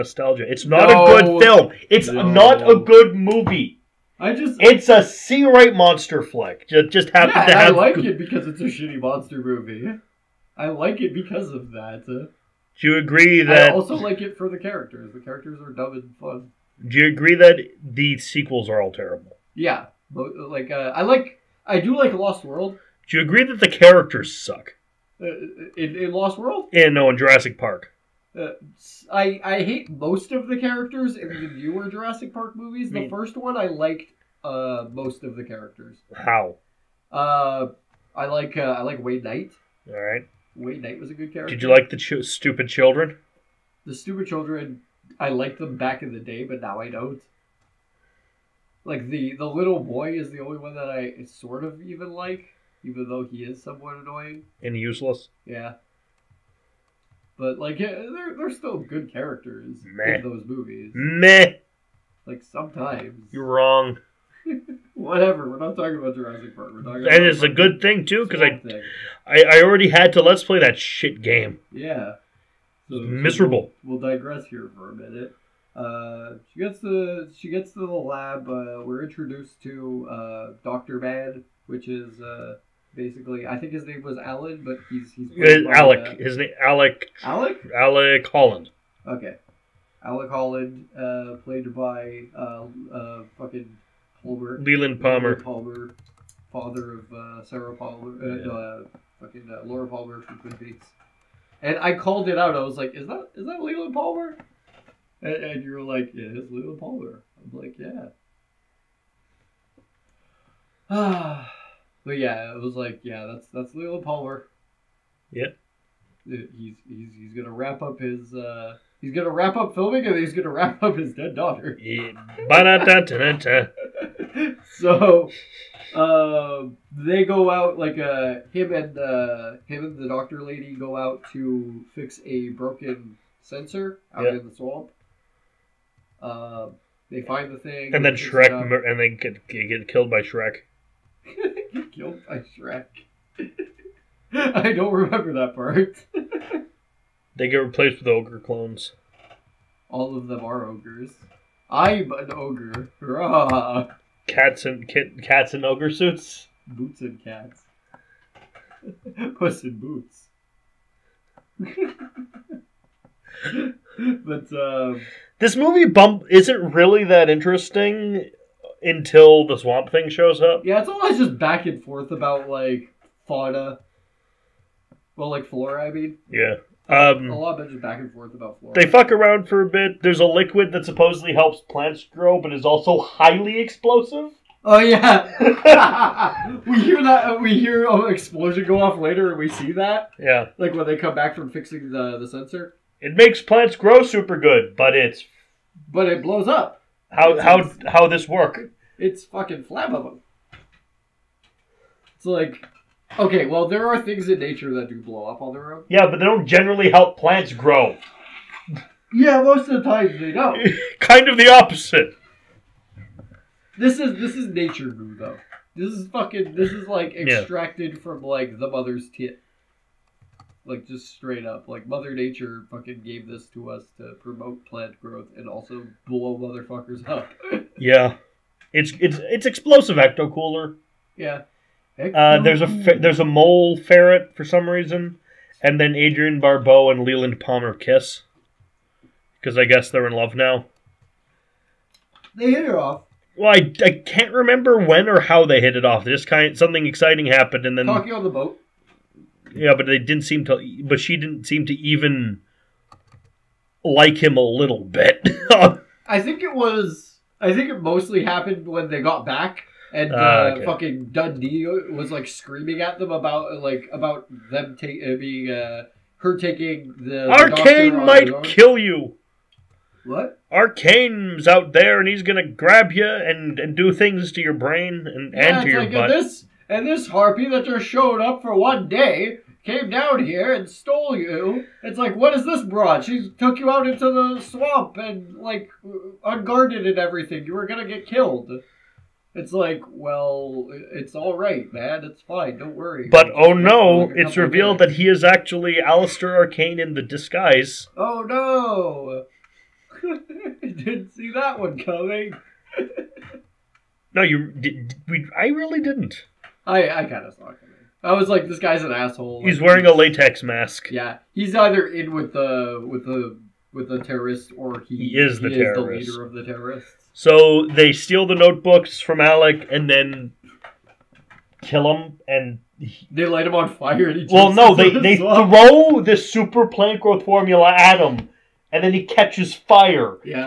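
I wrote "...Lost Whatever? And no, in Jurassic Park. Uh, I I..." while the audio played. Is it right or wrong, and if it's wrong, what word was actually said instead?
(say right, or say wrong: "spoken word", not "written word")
wrong: "World", not "Whatever".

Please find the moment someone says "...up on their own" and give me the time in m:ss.
3:25.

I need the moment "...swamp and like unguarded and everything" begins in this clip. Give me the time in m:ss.
4:44.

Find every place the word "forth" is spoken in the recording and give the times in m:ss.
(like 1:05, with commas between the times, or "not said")
2:51, 2:58.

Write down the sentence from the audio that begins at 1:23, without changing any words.
I think his name was Alan, but he's he's uh, Alec.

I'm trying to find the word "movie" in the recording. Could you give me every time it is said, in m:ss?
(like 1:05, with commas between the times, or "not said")
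0:03, 0:09, 0:32, 1:00, 2:45.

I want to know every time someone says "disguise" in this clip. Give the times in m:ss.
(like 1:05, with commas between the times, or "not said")
4:57.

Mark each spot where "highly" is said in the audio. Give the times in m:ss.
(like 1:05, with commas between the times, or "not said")
3:02.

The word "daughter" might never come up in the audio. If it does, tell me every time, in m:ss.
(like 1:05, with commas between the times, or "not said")
2:01.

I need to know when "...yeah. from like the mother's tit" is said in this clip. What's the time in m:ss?
3:37.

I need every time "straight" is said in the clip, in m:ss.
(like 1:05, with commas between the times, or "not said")
3:41.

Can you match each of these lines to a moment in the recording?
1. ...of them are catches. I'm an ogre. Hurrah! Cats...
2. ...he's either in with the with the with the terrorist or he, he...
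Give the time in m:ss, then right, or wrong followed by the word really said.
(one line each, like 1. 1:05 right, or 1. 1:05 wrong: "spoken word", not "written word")
1. 2:30 wrong: "ogres", not "catches"
2. 5:11 right.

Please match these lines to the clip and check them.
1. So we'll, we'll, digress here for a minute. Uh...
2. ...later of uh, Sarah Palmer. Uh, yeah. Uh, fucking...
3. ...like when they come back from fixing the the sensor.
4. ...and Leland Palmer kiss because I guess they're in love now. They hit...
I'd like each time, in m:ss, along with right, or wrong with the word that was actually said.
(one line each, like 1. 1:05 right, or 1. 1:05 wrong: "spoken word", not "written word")
1. 1:13 right
2. 1:36 wrong: "father", not "later"
3. 3:10 right
4. 3:56 right.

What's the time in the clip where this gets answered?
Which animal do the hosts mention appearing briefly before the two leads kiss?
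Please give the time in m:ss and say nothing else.
3:53.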